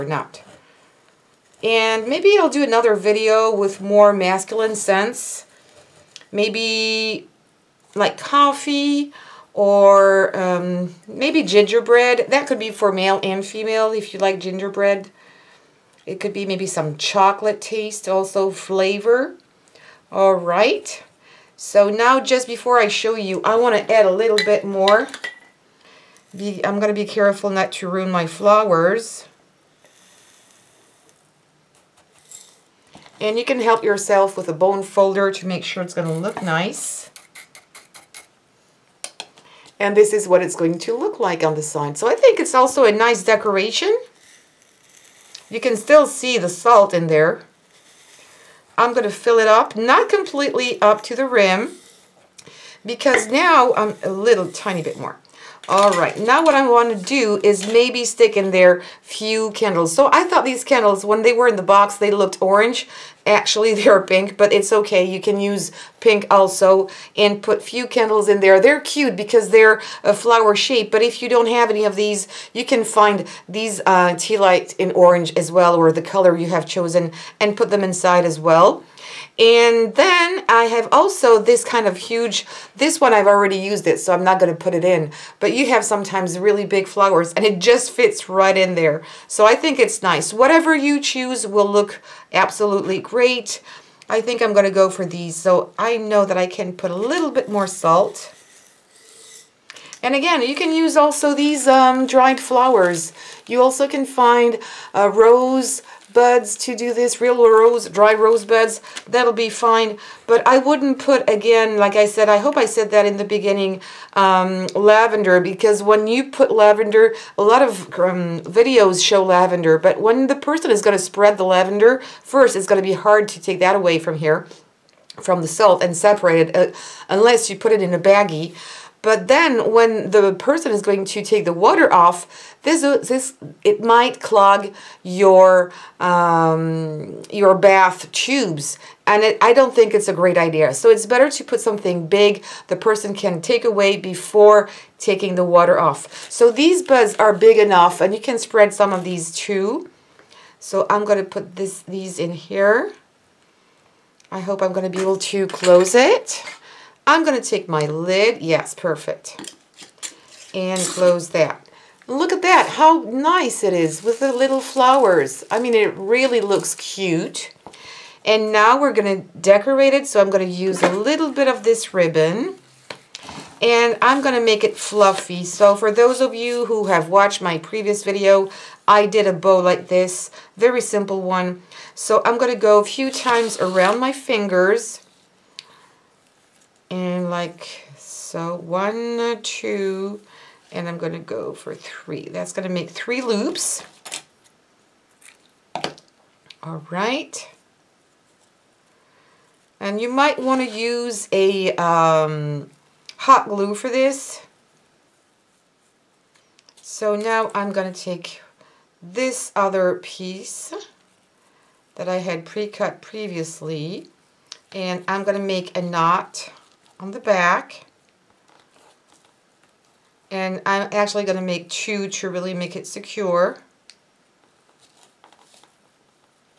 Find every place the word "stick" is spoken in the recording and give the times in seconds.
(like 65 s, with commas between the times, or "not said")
58 s.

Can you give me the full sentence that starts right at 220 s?
And I'm actually going to make two to really make it secure.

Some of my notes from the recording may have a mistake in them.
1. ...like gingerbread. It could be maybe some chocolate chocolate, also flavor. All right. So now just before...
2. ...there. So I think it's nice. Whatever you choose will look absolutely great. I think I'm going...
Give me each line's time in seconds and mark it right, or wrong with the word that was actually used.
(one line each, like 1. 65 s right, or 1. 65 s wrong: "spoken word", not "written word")
1. 14 s wrong: "taste", not "chocolate"
2. 88 s right.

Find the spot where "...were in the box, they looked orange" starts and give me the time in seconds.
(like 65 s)
61 s.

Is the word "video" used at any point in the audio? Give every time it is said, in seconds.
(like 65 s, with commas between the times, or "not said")
2 s, 118 s, 178 s.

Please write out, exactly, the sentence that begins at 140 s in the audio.
So it's better to put something big the person can take away before taking the water off.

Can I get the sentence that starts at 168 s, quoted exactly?
And now we're going to decorate it, so I'm going to use a little bit of this ribbon.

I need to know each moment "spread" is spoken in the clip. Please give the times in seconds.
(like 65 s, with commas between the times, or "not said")
121 s, 148 s.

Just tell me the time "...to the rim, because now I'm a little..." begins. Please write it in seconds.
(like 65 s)
51 s.